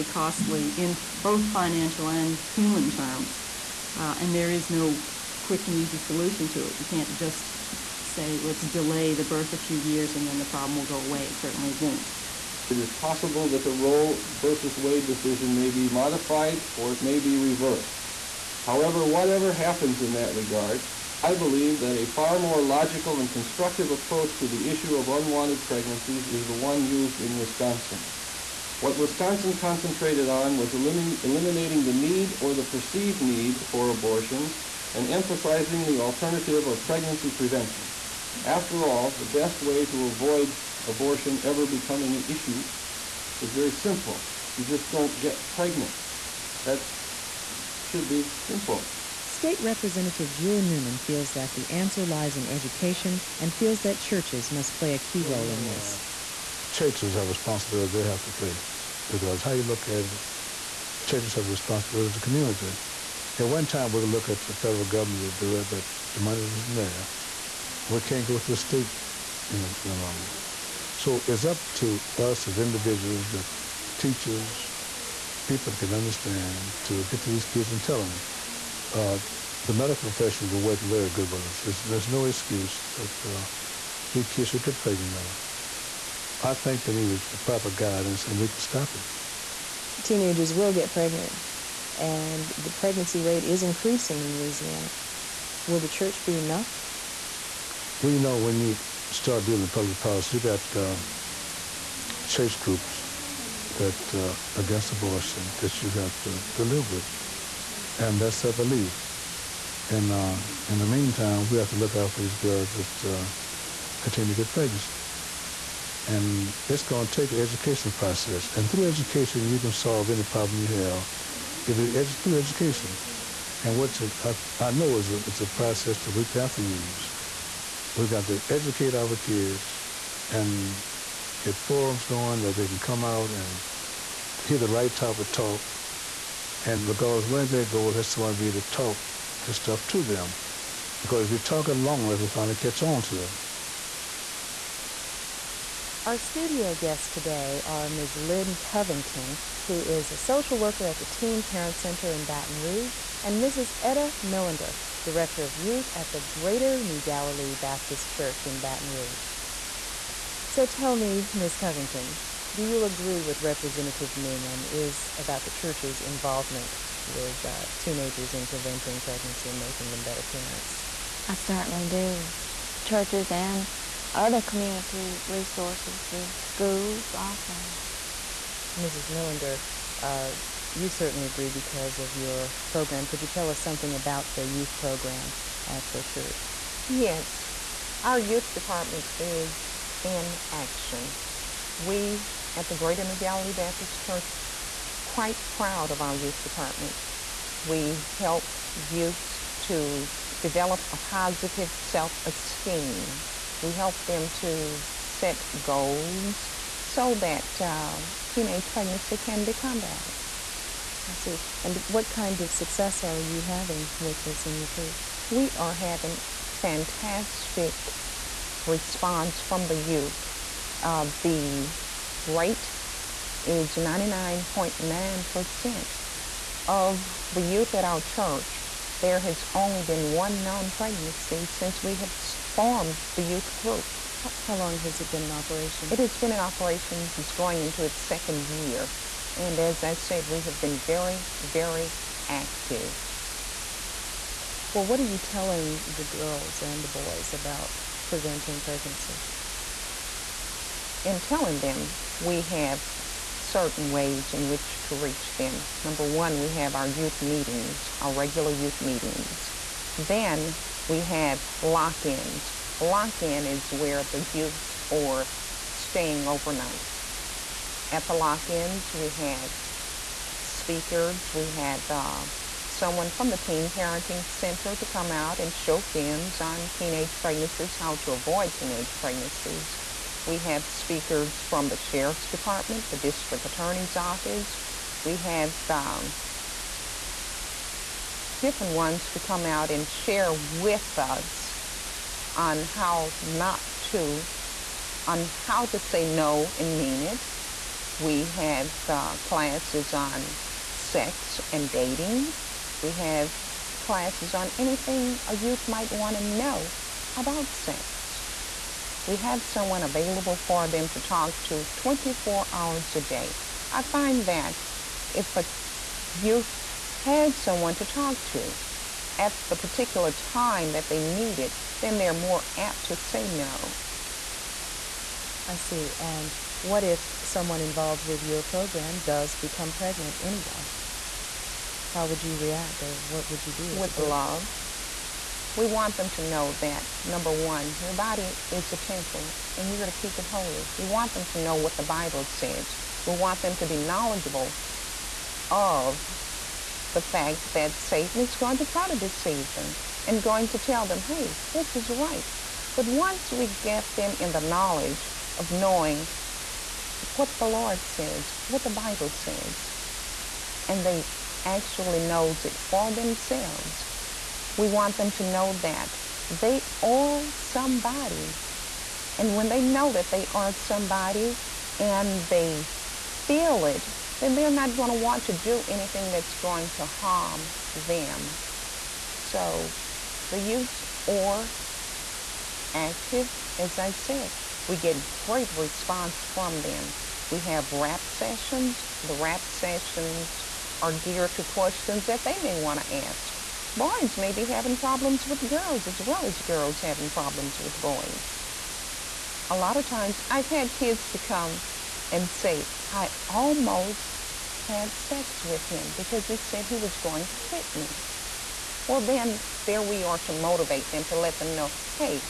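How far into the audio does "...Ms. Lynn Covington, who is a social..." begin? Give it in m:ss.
2:27.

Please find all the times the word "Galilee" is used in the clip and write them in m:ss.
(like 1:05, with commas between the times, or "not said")
2:36, 3:13.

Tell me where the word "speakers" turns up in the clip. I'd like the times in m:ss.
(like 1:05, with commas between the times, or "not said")
4:30, 4:40.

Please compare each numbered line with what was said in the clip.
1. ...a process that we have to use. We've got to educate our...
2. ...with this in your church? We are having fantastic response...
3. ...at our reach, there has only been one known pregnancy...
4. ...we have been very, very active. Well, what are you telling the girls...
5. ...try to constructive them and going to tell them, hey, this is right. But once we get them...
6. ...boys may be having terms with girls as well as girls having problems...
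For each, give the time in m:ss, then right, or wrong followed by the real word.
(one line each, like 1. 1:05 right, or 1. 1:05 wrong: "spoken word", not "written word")
1. 2:05 right
2. 3:33 right
3. 3:47 wrong: "church", not "reach"
4. 4:00 right
5. 5:48 wrong: "deceive", not "constructive"
6. 6:33 wrong: "problems", not "terms".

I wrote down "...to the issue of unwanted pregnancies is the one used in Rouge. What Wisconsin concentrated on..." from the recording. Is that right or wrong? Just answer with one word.
wrong.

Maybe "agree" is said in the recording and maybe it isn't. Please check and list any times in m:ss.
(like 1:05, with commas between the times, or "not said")
2:42, 3:01.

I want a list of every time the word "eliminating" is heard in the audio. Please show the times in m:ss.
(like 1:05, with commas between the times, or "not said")
0:30.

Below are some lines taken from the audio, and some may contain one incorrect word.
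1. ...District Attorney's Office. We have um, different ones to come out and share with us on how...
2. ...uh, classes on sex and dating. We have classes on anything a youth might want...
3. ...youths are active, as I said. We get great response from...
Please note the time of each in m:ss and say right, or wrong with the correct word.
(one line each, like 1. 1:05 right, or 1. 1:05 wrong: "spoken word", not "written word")
1. 4:42 right
2. 4:58 right
3. 6:20 right.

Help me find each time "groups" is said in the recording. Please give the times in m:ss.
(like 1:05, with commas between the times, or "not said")
1:42, 3:53.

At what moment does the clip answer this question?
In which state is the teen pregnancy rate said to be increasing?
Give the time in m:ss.
1:34.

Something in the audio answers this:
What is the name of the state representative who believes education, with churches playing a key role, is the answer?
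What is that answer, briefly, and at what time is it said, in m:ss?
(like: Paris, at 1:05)
Jewel Newman, at 0:50.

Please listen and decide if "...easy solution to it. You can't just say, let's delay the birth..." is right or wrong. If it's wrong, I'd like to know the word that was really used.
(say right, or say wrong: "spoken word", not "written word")
right.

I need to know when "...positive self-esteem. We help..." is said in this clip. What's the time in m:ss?
3:20.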